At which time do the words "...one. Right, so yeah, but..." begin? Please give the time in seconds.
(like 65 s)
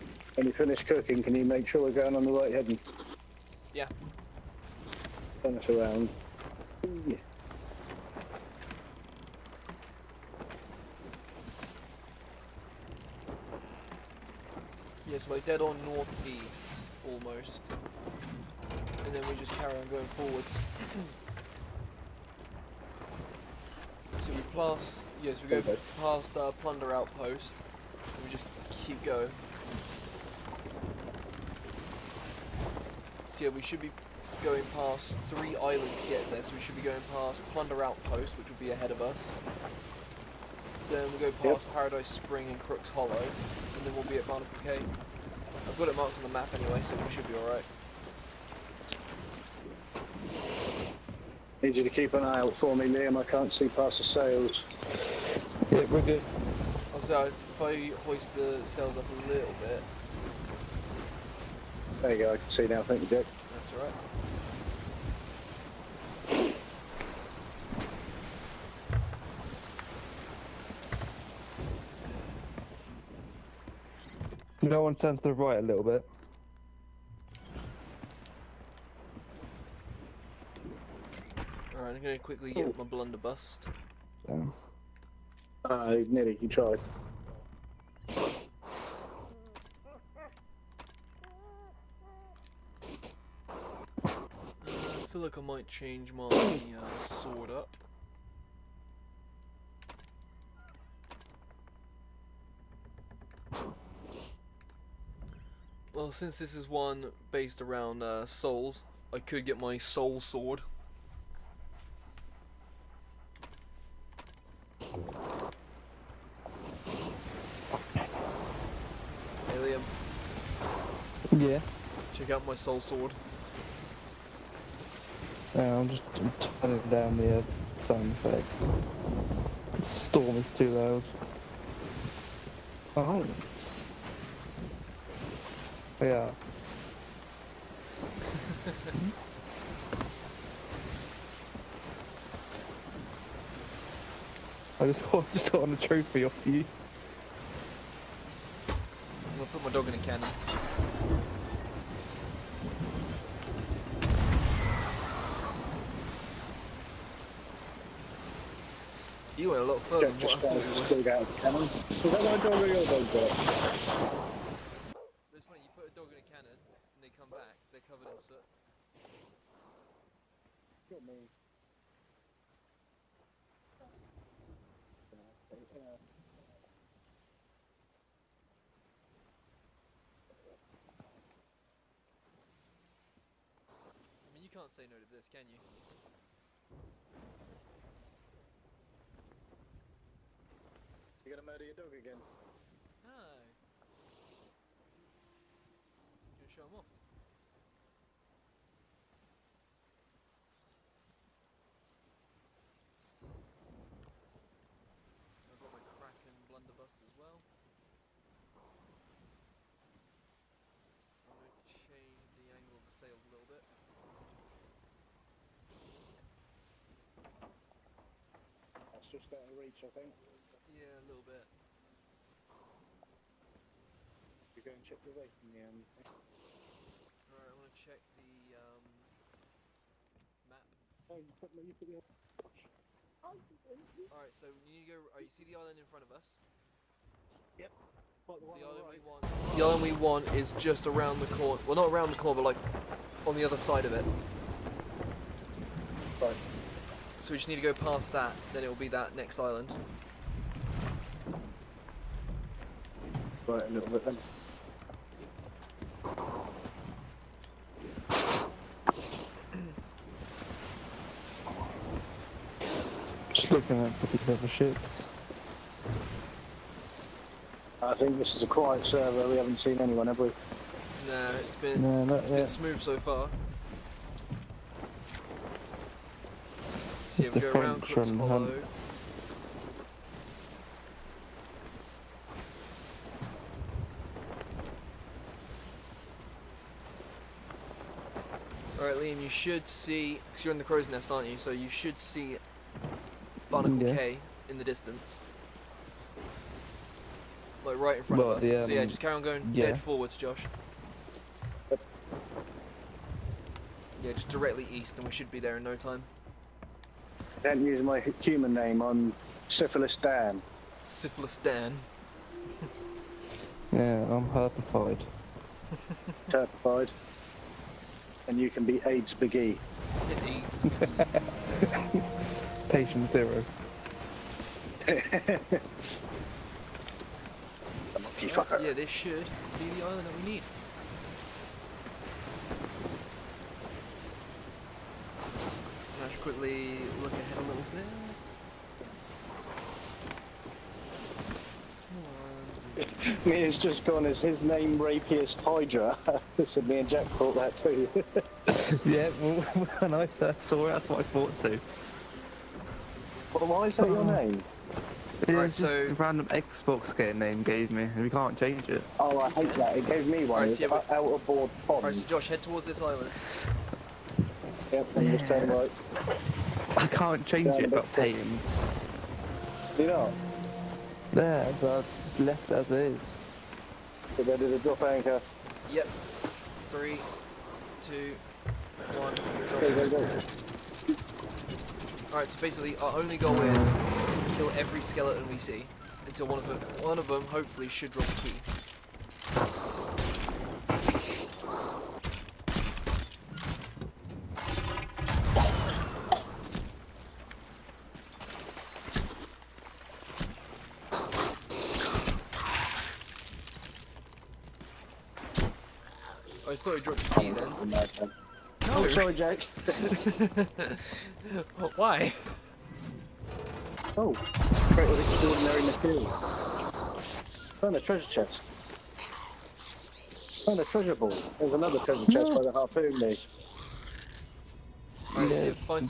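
360 s.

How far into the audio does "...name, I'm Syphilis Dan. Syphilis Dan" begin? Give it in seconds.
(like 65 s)
308 s.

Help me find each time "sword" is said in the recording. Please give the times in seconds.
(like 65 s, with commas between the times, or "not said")
97 s, 110 s, 122 s.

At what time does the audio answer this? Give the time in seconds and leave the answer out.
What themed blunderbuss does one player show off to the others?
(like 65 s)
205 s.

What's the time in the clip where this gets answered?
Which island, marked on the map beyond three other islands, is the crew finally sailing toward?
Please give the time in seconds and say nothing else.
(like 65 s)
44 s.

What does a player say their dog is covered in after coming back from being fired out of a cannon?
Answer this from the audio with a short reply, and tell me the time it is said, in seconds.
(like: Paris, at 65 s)
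soot, at 168 s.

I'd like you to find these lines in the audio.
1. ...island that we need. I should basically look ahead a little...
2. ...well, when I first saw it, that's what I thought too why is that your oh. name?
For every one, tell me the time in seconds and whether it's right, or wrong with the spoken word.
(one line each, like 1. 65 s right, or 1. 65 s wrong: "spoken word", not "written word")
1. 329 s wrong: "quickly", not "basically"
2. 349 s right.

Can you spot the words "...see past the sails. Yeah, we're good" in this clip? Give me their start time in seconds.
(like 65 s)
53 s.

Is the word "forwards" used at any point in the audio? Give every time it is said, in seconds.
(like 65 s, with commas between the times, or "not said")
20 s, 299 s.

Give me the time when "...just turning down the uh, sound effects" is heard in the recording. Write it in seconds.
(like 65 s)
125 s.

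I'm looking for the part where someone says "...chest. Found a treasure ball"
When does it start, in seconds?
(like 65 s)
418 s.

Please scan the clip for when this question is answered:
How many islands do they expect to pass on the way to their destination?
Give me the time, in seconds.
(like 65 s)
35 s.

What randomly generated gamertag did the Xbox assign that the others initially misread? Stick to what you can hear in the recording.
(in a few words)
Rapiest Hydra.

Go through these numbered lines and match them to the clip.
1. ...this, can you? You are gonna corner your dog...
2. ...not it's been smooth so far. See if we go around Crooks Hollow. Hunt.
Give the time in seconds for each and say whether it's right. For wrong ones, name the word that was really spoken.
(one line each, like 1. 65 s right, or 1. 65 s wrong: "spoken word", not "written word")
1. 185 s wrong: "murder", not "corner"
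2. 272 s right.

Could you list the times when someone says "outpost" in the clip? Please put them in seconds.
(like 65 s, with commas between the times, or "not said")
26 s, 37 s.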